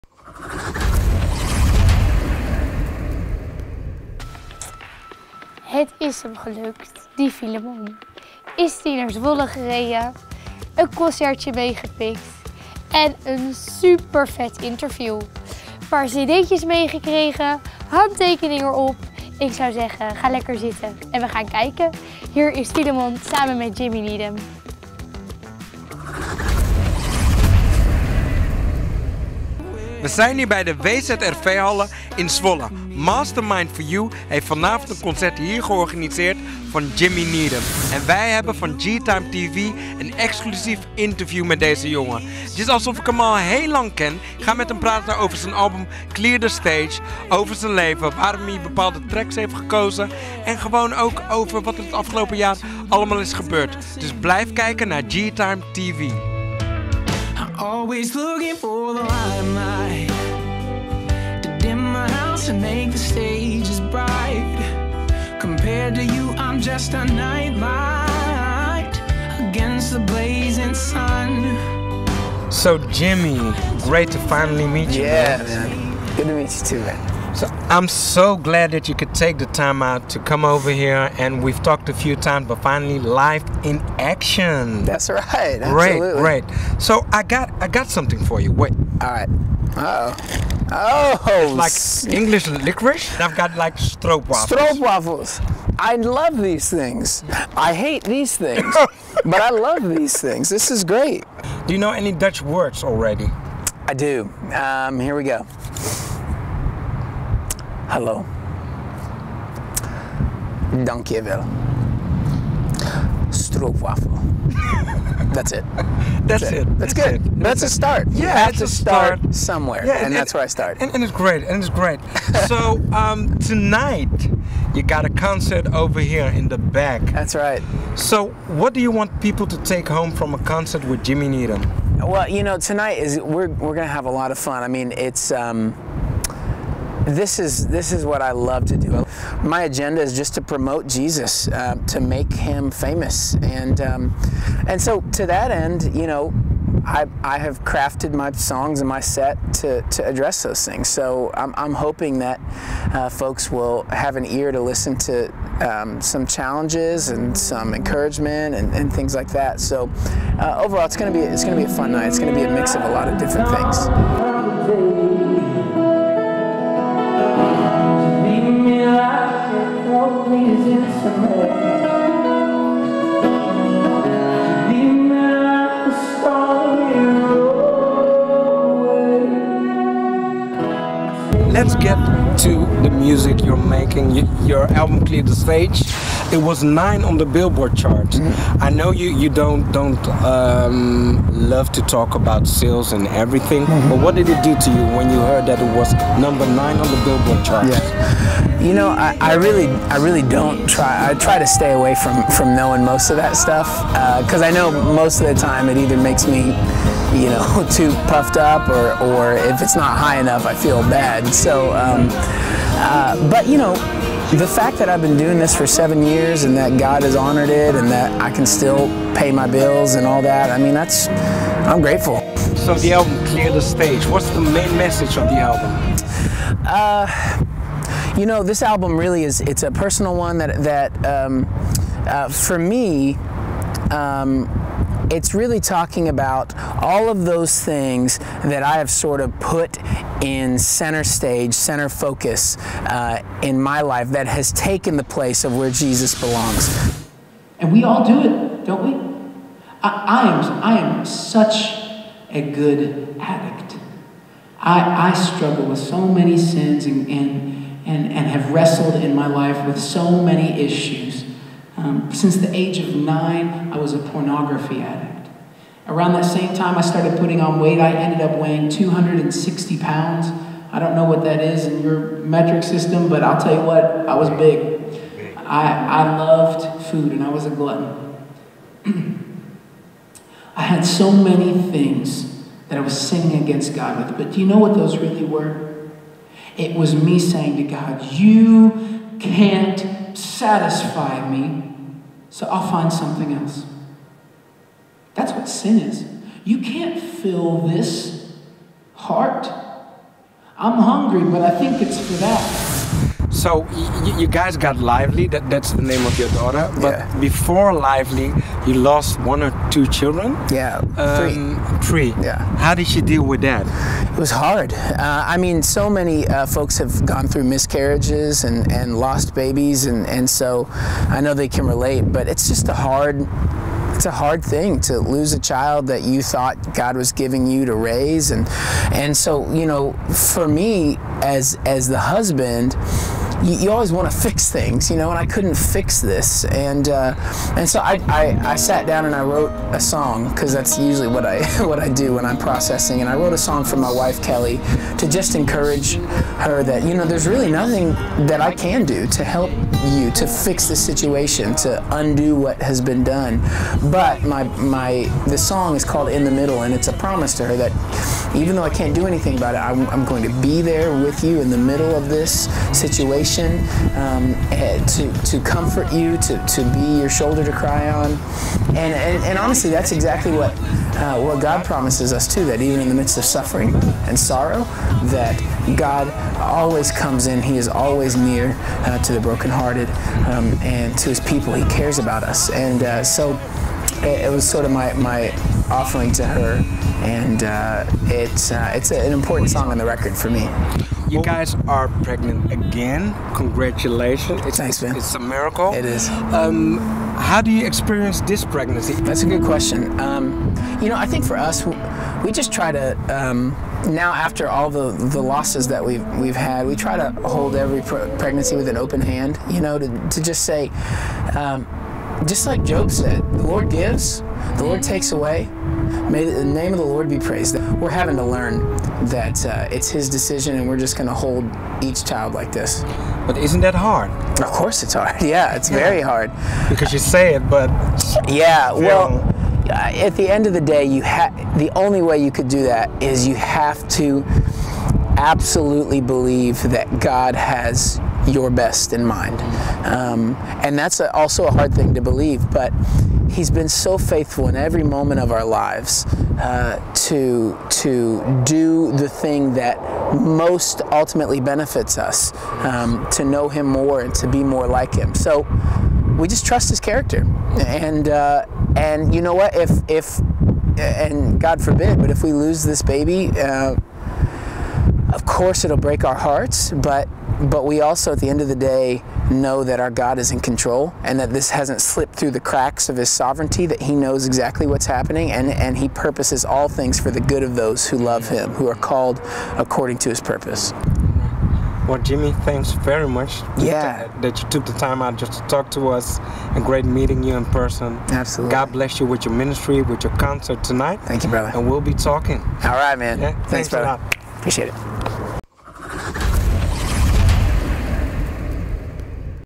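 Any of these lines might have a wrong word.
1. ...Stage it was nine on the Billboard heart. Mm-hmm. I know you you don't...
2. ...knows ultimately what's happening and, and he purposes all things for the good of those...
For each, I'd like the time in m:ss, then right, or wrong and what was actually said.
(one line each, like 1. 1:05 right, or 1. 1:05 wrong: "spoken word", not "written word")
1. 3:05 wrong: "chart", not "heart"
2. 7:53 wrong: "exactly", not "ultimately".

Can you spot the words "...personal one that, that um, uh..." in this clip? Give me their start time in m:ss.
3:49.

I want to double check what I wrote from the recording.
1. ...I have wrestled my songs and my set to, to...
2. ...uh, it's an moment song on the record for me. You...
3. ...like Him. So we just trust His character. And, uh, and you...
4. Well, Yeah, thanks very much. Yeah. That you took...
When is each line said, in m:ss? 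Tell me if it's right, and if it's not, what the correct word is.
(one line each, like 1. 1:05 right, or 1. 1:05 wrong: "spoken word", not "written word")
1. 2:27 wrong: "crafted", not "wrestled"
2. 6:28 wrong: "important", not "moment"
3. 7:34 right
4. 8:01 wrong: "Jimmy", not "Yeah".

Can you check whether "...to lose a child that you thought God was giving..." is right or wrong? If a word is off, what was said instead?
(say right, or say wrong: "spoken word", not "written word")
right.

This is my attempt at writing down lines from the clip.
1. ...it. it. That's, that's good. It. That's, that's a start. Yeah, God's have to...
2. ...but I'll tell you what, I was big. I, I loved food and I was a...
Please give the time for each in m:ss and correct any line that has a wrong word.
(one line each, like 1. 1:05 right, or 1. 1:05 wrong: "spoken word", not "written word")
1. 1:56 wrong: "That", not "God"
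2. 4:33 right.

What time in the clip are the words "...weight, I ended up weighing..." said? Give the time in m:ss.
4:27.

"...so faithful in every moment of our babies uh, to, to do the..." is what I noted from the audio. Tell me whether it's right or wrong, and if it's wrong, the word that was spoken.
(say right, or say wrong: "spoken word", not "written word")
wrong: "lives", not "babies".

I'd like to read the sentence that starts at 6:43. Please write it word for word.
Um, now after all the, the losses that we've we've had, we try to hold every pregnancy with an open hand.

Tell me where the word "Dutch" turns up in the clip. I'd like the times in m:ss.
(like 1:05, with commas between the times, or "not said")
1:42.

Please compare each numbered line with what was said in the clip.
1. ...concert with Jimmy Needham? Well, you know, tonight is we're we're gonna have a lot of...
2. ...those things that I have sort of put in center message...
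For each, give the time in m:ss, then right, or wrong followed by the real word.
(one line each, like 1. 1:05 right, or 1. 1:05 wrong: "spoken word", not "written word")
1. 2:10 right
2. 3:57 wrong: "stage", not "message".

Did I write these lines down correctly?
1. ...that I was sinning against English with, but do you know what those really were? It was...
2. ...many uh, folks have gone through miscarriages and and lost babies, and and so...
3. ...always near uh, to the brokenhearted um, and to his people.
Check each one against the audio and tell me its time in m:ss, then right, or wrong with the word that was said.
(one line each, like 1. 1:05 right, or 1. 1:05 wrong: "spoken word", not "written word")
1. 4:42 wrong: "God", not "English"
2. 5:15 right
3. 6:17 right.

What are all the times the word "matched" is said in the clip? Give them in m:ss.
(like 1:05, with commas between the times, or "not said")
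not said.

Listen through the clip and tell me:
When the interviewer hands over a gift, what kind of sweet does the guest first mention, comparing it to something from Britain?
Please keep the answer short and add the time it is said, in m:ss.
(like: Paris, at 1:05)
English licorice, at 1:32.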